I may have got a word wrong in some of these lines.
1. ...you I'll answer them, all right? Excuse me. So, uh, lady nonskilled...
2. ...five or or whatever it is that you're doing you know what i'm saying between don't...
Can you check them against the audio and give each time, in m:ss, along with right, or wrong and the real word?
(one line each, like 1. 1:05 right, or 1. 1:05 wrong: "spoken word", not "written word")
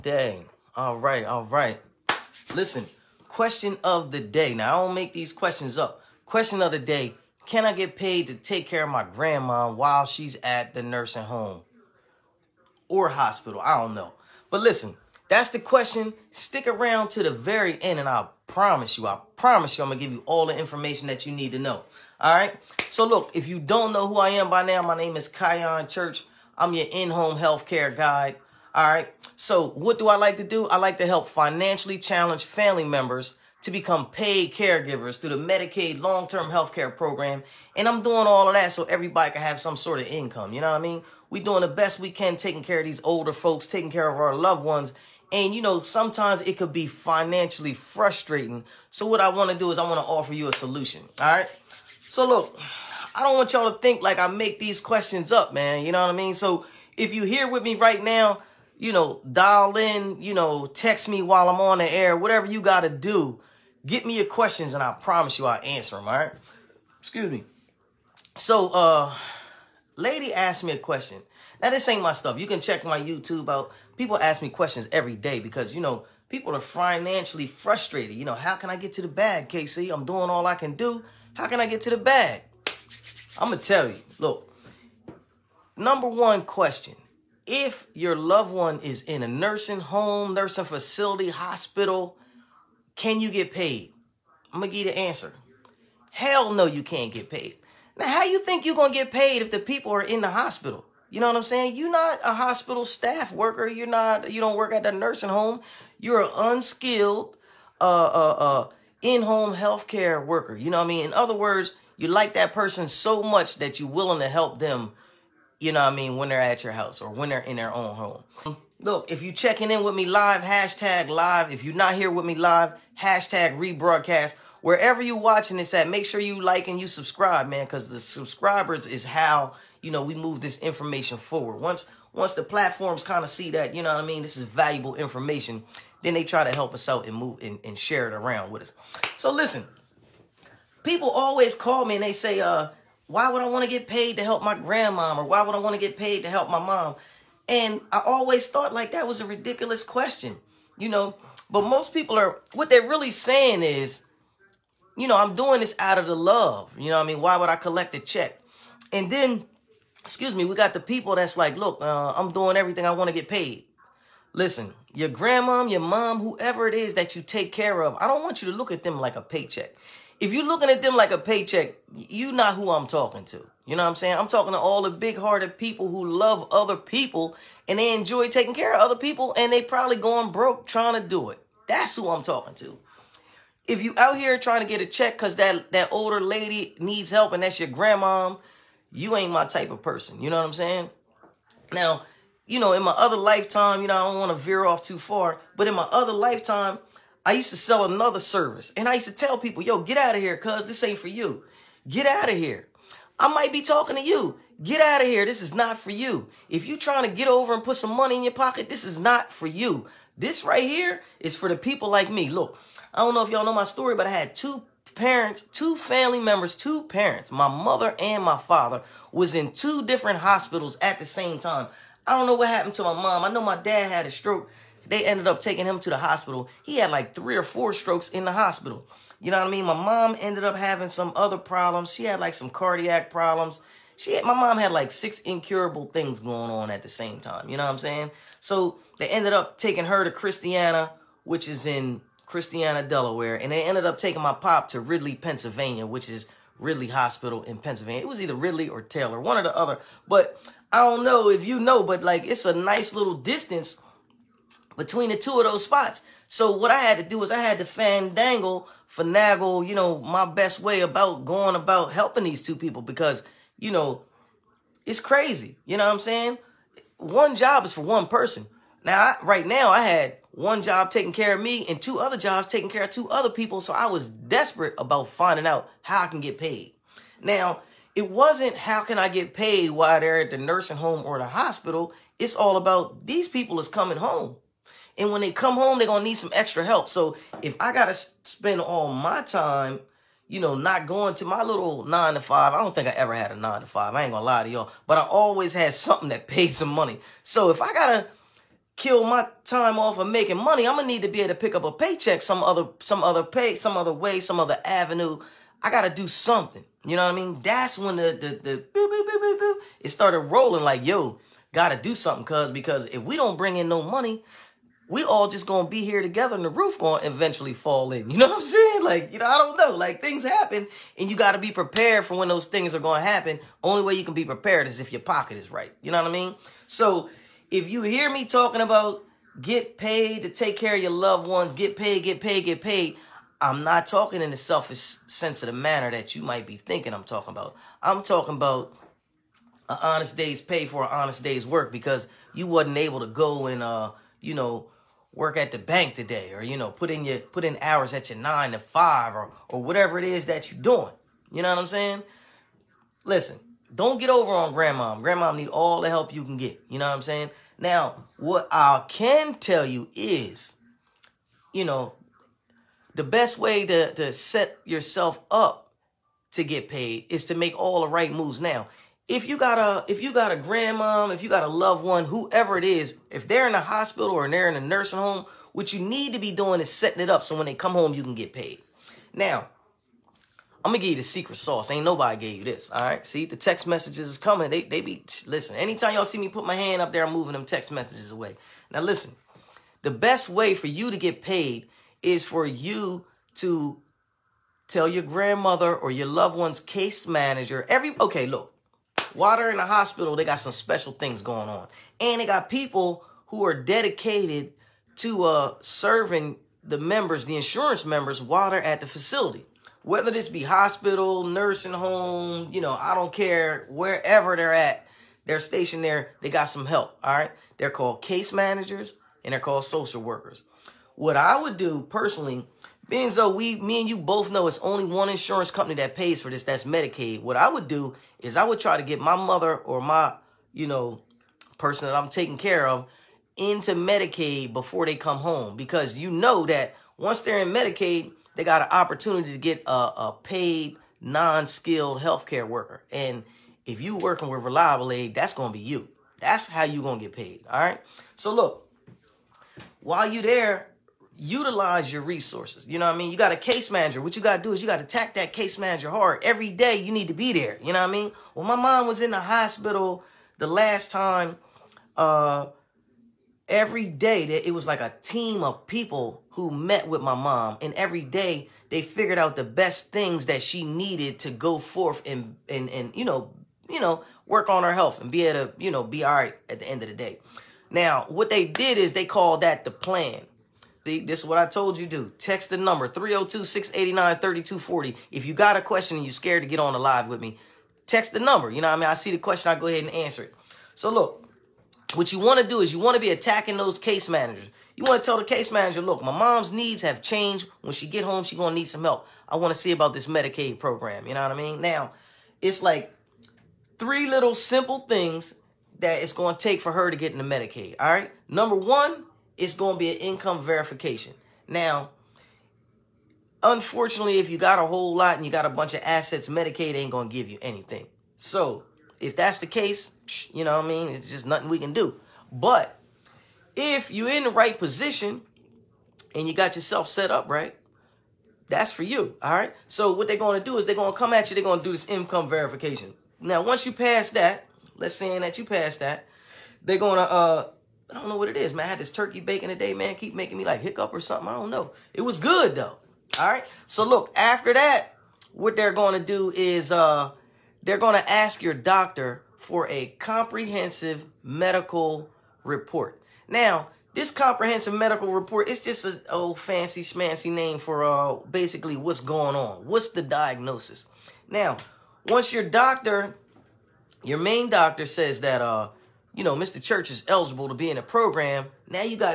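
1. 1:05 wrong: "asked", not "nonskilled"
2. 5:48 wrong: "listen", not "between".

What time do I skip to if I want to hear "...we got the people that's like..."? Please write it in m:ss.
2:40.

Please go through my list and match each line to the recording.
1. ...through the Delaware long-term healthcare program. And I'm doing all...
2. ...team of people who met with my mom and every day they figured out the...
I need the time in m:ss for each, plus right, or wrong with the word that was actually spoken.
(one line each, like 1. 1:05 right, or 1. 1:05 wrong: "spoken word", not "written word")
1. 0:35 wrong: "Medicaid", not "Delaware"
2. 7:45 right.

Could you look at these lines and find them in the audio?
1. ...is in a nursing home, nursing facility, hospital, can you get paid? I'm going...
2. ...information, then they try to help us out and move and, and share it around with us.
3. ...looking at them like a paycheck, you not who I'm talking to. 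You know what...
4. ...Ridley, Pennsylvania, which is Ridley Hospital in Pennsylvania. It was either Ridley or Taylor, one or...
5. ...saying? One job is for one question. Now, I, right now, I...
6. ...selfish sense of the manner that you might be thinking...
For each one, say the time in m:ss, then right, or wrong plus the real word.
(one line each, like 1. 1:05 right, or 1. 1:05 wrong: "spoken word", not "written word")
1. 1:28 right
2. 2:14 right
3. 2:50 right
4. 4:04 right
5. 4:25 wrong: "person", not "question"
6. 5:34 right.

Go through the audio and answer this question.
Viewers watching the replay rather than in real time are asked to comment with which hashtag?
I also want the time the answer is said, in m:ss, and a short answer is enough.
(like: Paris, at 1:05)
#rebroadcast, at 2:03.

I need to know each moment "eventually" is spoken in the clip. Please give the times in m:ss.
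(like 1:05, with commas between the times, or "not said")
5:17.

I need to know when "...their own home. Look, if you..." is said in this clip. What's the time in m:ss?
1:57.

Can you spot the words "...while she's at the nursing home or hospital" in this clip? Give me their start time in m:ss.
0:09.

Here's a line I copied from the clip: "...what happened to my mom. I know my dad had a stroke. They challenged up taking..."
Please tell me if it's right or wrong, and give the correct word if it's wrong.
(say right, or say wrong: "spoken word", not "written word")
wrong: "ended", not "challenged".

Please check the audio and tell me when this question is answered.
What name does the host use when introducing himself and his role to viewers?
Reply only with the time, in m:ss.
0:25.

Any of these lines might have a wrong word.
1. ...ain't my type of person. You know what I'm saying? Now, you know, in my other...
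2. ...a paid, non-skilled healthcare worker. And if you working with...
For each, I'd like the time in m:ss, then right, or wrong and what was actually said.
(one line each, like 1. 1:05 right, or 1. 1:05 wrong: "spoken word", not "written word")
1. 3:09 right
2. 7:19 right.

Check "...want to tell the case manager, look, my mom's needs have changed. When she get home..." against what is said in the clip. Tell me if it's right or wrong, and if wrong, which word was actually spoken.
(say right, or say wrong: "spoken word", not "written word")
right.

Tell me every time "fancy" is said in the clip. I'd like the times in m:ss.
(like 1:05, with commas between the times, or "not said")
9:16.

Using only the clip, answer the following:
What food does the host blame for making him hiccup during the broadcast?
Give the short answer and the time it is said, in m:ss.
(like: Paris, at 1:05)
Turkey bacon, at 8:58.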